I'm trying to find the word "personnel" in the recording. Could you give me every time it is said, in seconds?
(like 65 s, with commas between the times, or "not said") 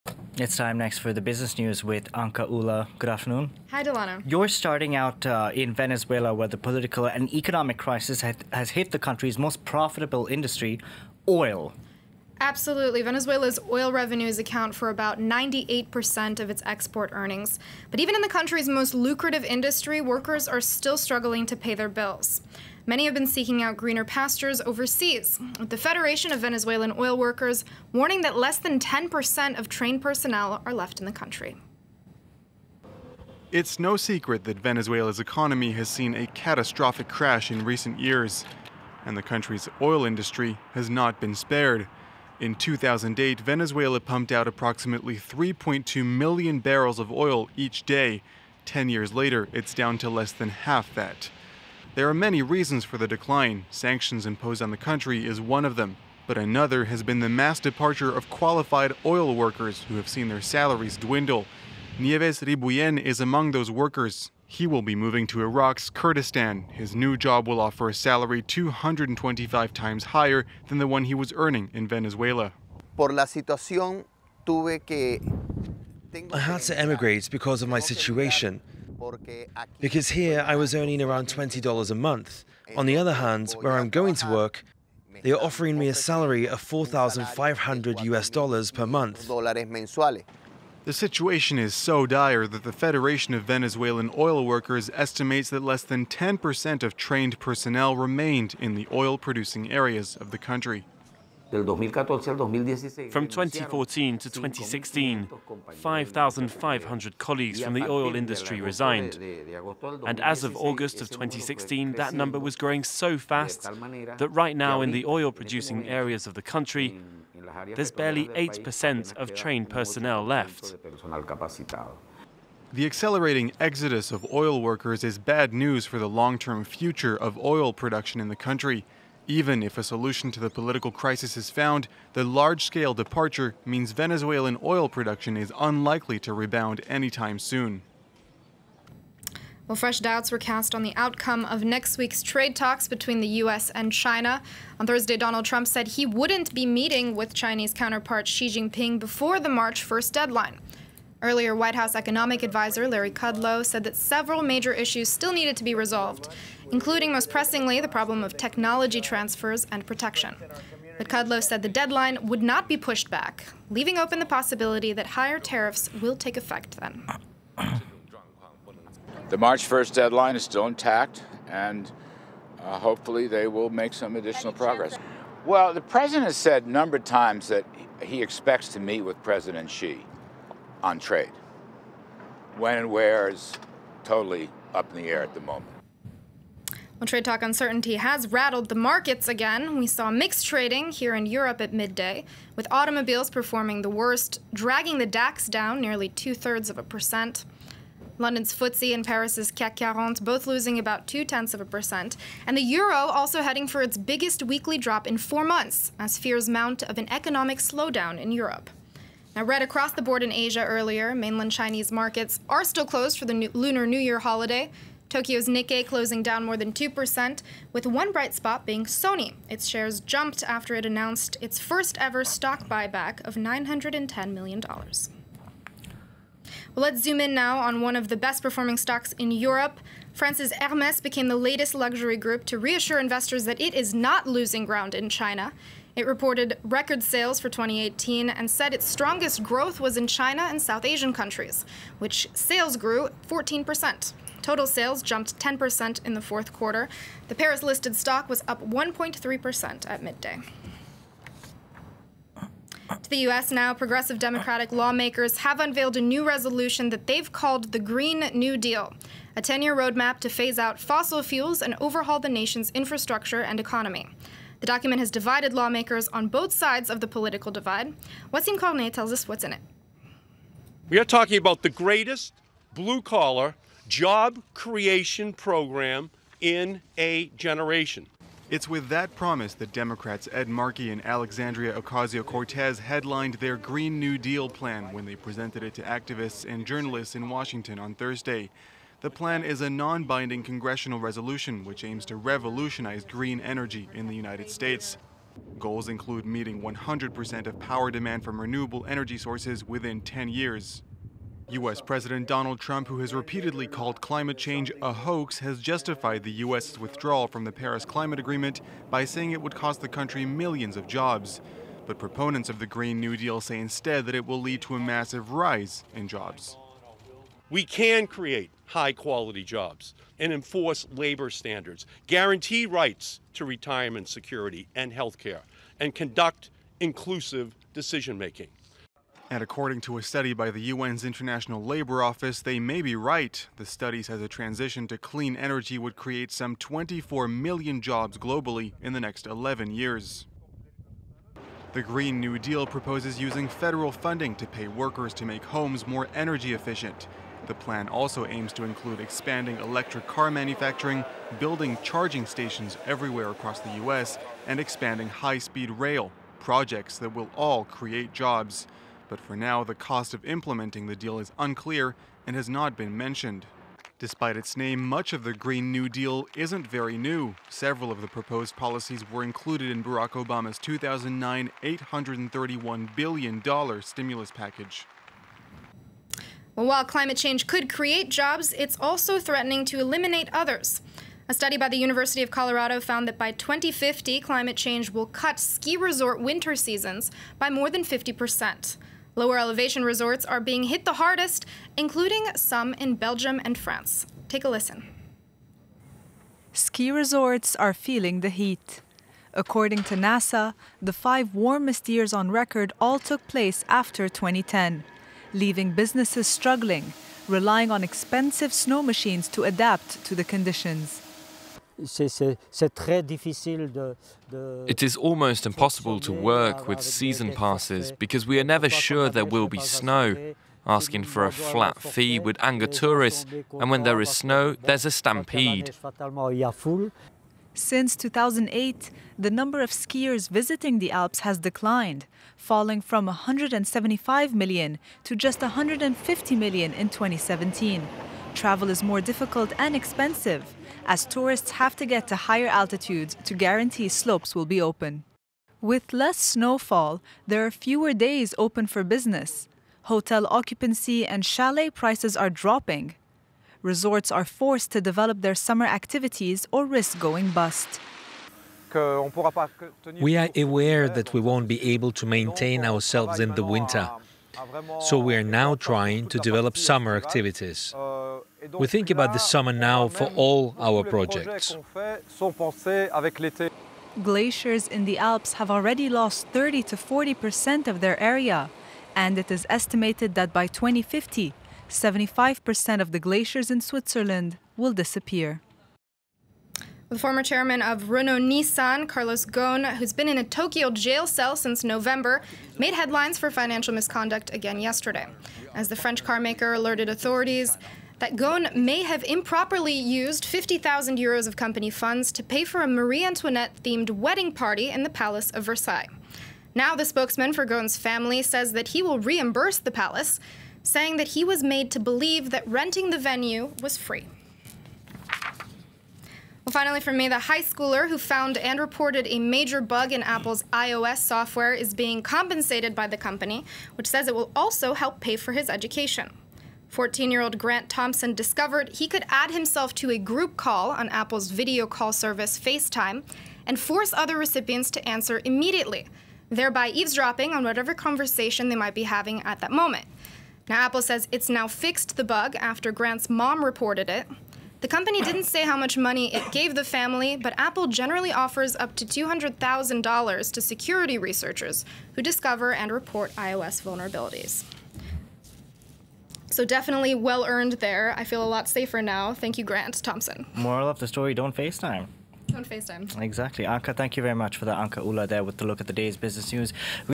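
30 s, 97 s, 119 s.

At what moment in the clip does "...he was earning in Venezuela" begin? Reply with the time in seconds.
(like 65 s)
71 s.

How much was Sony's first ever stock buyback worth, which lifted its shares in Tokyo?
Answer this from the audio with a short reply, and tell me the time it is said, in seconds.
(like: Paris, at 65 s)
$910 million, at 223 s.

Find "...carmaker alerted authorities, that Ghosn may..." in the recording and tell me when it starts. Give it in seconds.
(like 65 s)
496 s.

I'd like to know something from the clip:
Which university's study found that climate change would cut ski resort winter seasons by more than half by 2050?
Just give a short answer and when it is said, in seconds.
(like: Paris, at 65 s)
University of Colorado, at 381 s.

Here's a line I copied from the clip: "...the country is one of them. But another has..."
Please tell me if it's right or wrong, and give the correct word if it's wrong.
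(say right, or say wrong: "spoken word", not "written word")
right.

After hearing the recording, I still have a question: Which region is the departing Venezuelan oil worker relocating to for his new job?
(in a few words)
Iraq's Kurdistan.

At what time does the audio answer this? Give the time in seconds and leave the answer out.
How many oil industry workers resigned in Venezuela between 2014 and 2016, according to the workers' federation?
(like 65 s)
105 s.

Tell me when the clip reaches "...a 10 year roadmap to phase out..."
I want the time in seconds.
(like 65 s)
259 s.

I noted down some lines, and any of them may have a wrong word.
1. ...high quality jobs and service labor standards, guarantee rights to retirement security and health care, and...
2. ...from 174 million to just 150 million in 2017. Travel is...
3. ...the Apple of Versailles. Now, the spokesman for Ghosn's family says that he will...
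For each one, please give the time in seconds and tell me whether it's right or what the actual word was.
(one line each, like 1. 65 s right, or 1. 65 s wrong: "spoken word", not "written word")
1. 318 s wrong: "enforce", not "service"
2. 432 s wrong: "175", not "174"
3. 504 s wrong: "Palace", not "Apple".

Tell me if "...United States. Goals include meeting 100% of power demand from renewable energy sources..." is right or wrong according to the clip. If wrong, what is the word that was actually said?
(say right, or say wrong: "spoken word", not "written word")
right.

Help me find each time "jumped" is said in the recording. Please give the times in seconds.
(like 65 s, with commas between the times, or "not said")
219 s, 245 s.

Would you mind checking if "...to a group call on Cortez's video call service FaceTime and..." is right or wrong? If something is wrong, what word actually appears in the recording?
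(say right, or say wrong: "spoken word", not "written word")
wrong: "Apple", not "Cortez".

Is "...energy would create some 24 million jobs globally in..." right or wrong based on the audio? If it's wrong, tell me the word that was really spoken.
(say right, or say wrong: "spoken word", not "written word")
right.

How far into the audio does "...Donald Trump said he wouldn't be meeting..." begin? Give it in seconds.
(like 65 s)
145 s.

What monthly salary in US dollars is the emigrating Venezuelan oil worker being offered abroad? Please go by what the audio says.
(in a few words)
$4,500.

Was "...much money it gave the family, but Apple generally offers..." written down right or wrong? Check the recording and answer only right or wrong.
right.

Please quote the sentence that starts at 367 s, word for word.
Several of the proposed policies were included in Barack Obama's 2009 $831 billion stimulus package.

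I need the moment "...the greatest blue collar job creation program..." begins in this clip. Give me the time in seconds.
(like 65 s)
271 s.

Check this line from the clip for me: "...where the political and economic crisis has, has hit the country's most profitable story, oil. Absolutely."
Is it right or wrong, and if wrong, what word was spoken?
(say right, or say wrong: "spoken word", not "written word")
wrong: "industry", not "story".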